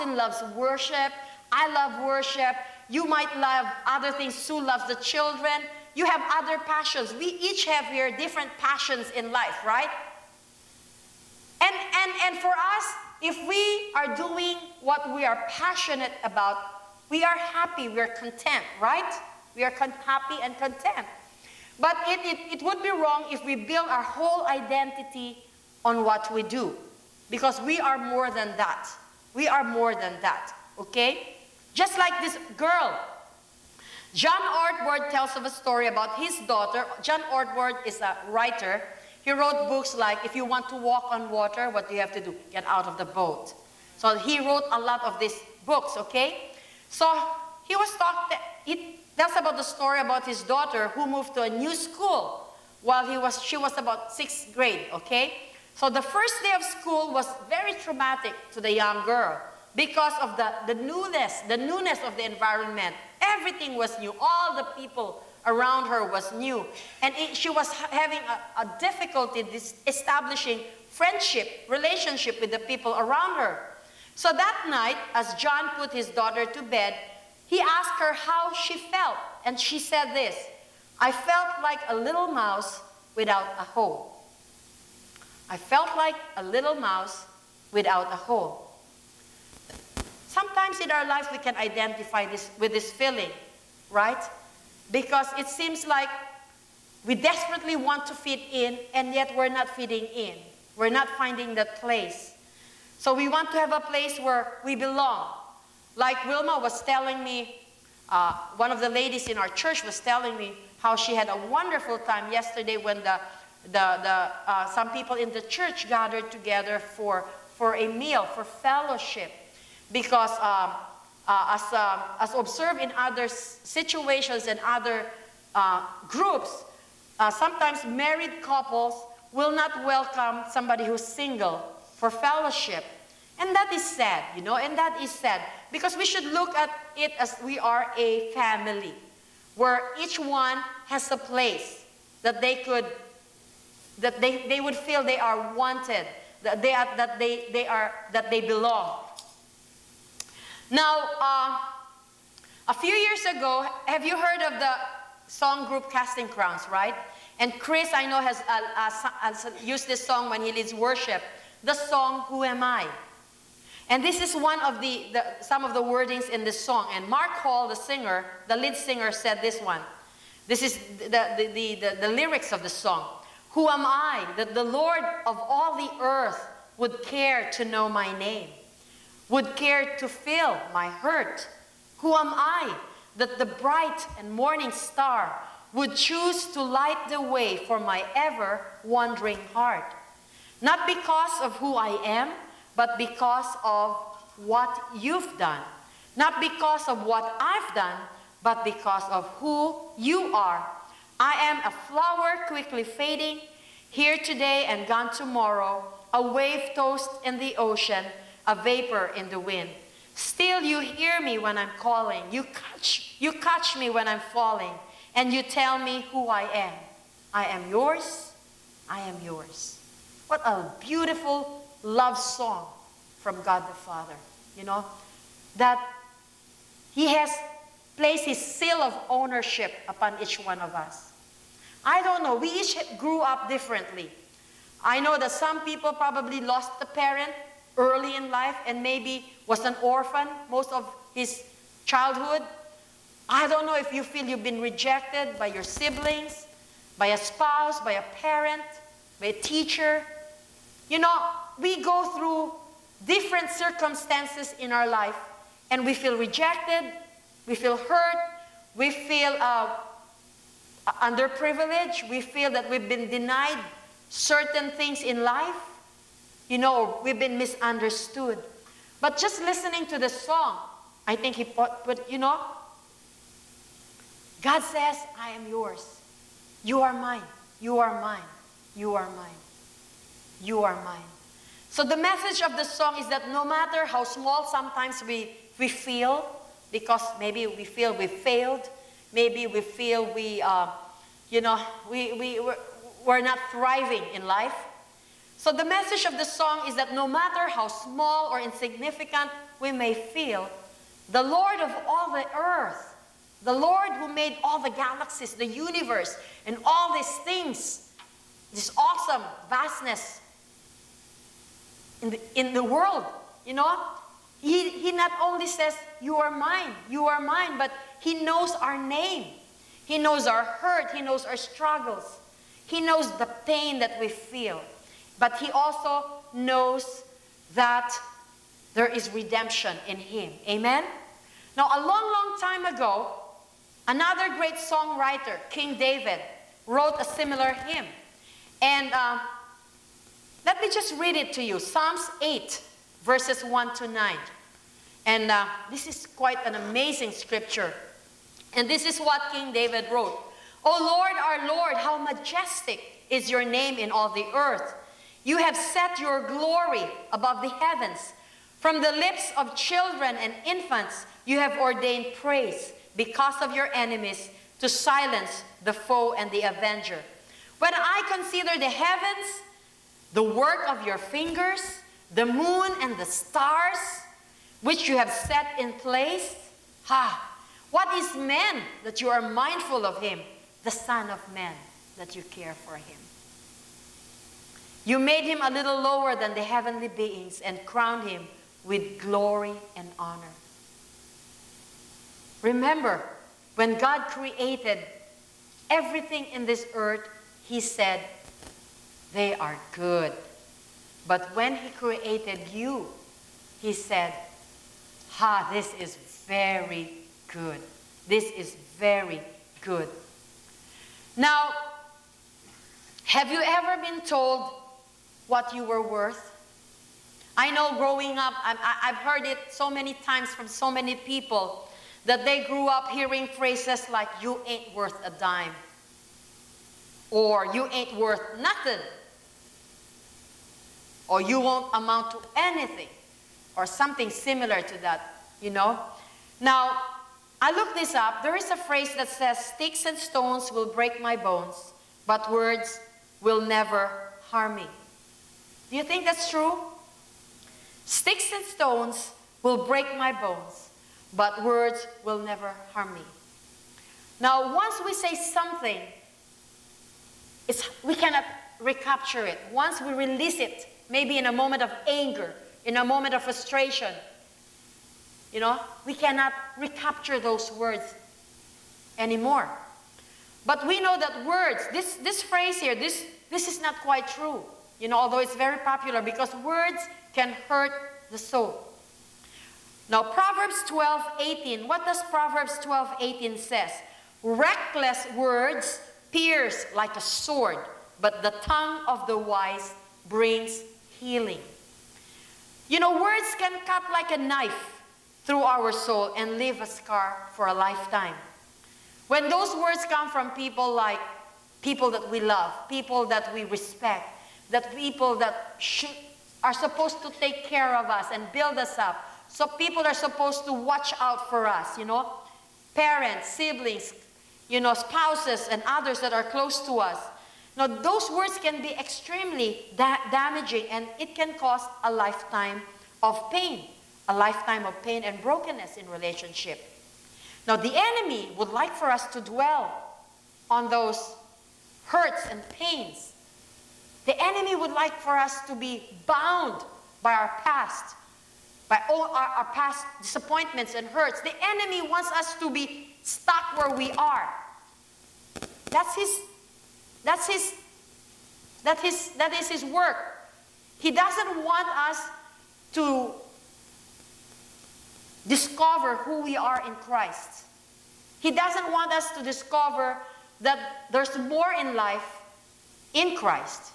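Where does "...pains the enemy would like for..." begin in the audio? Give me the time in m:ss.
8:52.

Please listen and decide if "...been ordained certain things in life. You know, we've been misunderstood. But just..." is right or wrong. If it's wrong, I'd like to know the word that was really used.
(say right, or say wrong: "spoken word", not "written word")
wrong: "denied", not "ordained".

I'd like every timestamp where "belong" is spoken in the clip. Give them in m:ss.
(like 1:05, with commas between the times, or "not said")
1:44, 2:28.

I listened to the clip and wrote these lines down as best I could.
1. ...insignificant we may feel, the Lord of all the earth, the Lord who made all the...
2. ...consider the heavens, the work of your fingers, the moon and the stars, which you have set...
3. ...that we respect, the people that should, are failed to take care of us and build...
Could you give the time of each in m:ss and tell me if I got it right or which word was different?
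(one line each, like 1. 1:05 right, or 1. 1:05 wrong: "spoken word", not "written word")
1. 4:58 right
2. 6:08 right
3. 8:23 wrong: "supposed", not "failed".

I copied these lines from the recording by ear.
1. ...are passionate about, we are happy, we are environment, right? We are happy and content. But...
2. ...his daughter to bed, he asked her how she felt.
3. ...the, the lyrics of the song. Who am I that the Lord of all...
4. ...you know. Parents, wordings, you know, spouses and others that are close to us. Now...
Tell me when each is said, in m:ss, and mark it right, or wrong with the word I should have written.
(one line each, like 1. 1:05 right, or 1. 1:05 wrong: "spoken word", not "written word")
1. 0:15 wrong: "content", not "environment"
2. 1:15 right
3. 2:51 right
4. 8:31 wrong: "siblings", not "wordings".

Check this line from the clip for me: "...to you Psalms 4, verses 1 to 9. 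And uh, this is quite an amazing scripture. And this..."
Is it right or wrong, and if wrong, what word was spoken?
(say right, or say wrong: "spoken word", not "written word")
wrong: "8", not "4".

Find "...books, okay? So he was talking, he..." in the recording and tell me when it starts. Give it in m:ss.
0:45.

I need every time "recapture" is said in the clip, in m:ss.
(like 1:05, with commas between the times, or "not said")
7:38, 7:46.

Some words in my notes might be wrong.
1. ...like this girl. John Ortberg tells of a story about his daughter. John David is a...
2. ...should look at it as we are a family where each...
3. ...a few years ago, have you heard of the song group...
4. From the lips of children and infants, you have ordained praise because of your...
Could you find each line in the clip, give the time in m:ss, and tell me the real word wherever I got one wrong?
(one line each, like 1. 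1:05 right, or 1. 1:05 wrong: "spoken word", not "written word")
1. 0:31 wrong: "Ortberg", not "David"
2. 2:16 right
3. 2:32 right
4. 5:58 right.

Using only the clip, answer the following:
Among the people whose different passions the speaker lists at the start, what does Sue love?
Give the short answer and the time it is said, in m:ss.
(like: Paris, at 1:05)
The children, at 0:04.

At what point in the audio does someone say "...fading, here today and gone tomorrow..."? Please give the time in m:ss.
3:22.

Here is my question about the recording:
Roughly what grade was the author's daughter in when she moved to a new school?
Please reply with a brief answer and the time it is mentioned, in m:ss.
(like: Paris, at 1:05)
Sixth grade, at 0:54.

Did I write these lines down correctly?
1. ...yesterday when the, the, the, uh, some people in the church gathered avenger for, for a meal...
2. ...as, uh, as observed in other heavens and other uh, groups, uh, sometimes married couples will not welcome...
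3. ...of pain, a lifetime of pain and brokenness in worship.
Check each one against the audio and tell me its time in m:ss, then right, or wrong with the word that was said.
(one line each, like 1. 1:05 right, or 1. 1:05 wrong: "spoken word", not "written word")
1. 1:52 wrong: "together", not "avenger"
2. 2:01 wrong: "situations", not "heavens"
3. 8:43 wrong: "relationship", not "worship".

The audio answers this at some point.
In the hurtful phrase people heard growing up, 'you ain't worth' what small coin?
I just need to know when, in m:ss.
7:05.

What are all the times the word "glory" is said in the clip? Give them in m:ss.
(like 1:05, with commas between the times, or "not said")
5:56, 6:28.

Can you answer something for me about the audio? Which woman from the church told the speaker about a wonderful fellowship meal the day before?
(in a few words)
Wilma.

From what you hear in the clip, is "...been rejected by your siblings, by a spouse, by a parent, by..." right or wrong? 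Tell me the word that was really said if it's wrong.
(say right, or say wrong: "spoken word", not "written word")
right.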